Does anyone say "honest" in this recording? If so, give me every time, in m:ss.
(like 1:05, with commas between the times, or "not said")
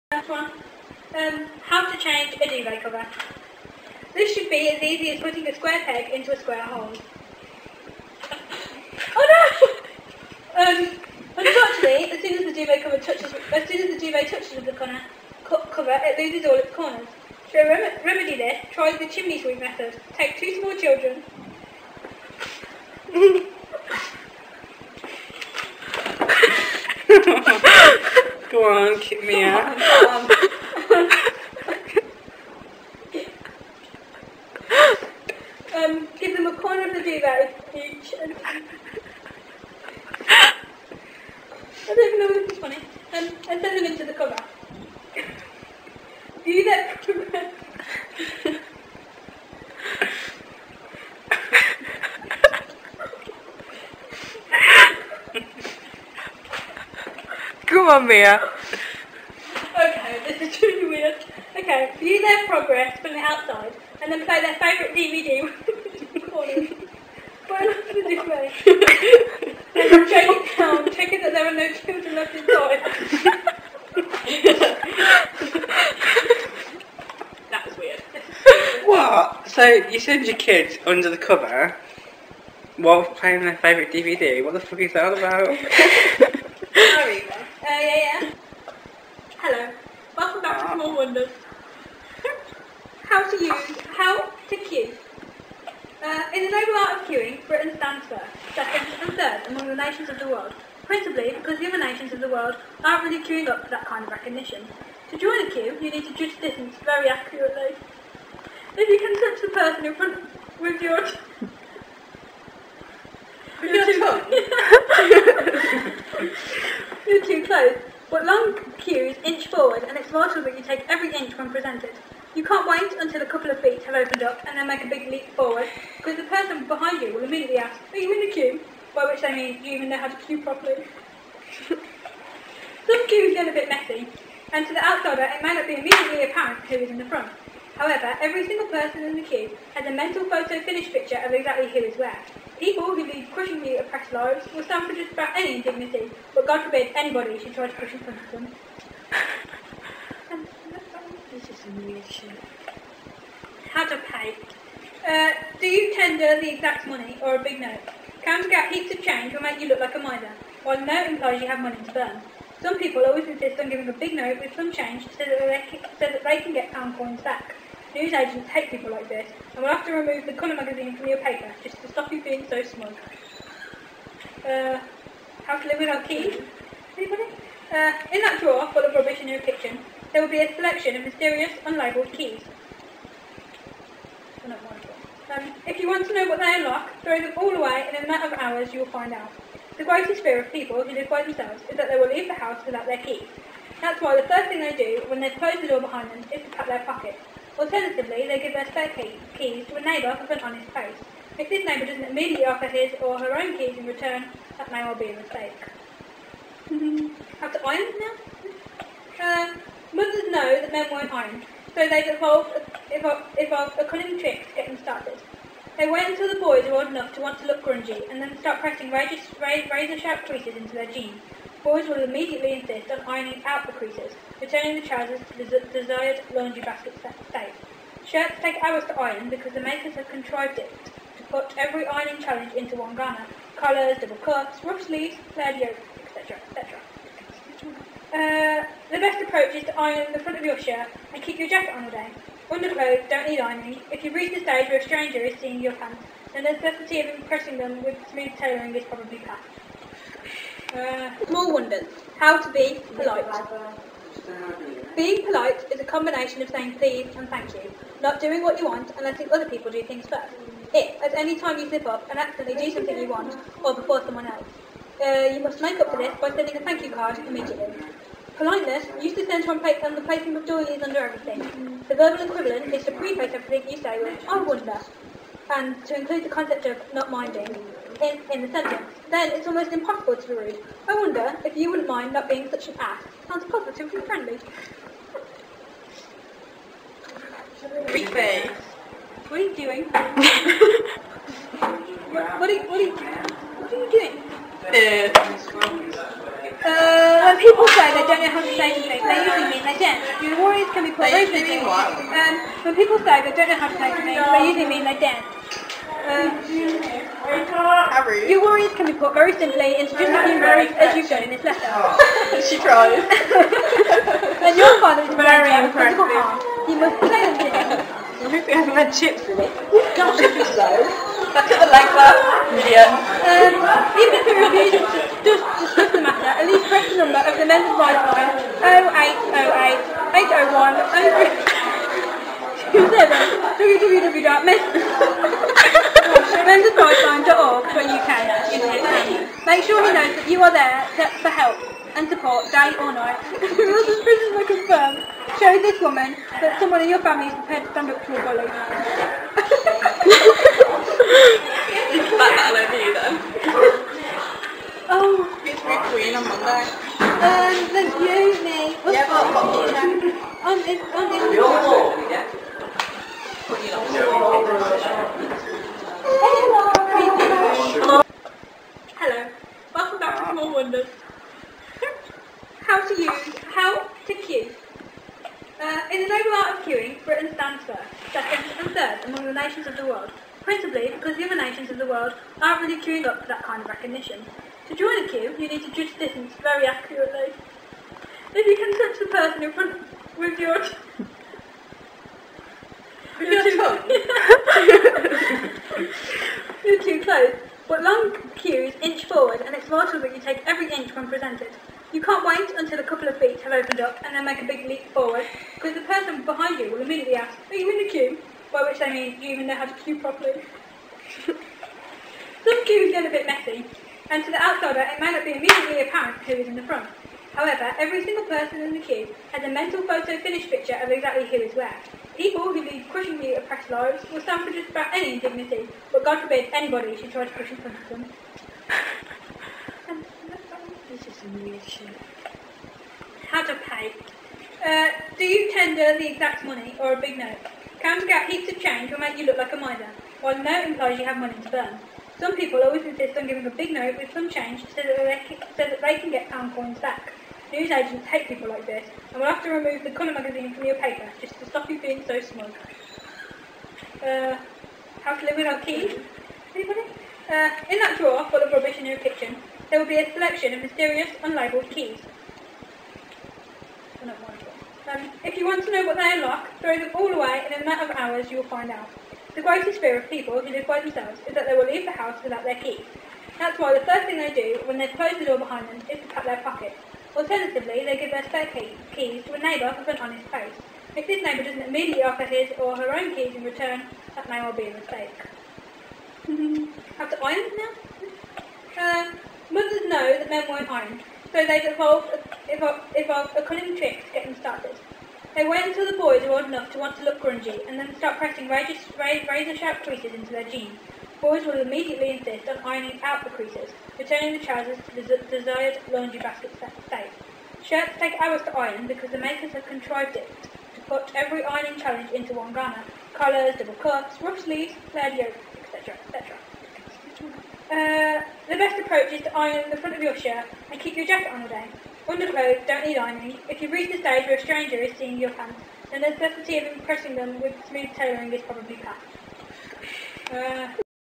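8:00.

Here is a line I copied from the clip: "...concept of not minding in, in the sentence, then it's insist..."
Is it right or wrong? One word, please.
wrong.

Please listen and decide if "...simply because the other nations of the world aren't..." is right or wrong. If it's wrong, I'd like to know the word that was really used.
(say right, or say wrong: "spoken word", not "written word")
wrong: "principally", not "simply".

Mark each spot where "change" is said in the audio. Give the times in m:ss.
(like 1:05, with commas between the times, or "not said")
0:01, 2:39, 2:44, 7:18, 7:24.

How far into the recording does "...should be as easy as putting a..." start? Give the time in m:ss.
0:04.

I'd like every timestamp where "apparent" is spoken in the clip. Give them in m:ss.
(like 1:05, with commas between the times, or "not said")
2:16, 6:55.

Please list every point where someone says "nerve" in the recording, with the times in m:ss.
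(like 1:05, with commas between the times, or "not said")
not said.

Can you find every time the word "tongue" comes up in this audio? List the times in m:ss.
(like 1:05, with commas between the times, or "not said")
1:57, 6:33.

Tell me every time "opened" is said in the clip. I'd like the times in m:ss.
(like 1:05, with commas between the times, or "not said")
2:03, 6:43.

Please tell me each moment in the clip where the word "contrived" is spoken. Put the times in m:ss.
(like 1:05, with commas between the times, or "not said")
3:50, 8:29.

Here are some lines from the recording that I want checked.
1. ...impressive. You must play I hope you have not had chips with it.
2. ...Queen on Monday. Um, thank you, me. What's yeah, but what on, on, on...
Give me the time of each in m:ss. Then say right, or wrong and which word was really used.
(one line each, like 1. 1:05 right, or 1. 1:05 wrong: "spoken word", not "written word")
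1. 5:15 right
2. 5:55 right.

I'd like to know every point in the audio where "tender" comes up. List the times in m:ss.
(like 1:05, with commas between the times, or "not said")
2:35, 7:15.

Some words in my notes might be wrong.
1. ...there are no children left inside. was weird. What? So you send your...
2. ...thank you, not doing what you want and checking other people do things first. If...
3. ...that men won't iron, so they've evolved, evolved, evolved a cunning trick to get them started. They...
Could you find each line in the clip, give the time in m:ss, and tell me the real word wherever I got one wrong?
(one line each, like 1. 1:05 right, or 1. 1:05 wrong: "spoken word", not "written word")
1. 1:11 right
2. 4:17 wrong: "letting", not "checking"
3. 8:10 right.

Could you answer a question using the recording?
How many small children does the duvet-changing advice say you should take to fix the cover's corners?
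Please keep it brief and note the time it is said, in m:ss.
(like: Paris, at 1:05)
2, at 0:20.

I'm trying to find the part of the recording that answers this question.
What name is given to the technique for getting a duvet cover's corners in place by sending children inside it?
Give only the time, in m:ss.
0:19.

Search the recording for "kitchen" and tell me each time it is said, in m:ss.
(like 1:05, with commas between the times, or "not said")
2:59, 7:38.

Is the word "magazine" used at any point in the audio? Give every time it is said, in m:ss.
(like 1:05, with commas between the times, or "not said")
2:50, 7:30.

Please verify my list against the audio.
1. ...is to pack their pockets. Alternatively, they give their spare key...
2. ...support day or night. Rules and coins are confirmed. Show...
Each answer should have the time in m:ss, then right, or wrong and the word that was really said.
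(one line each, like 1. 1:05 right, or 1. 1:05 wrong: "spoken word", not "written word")
1. 3:16 right
2. 5:42 wrong: "prisons", not "coins".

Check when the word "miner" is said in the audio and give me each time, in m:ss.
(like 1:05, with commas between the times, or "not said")
7:19.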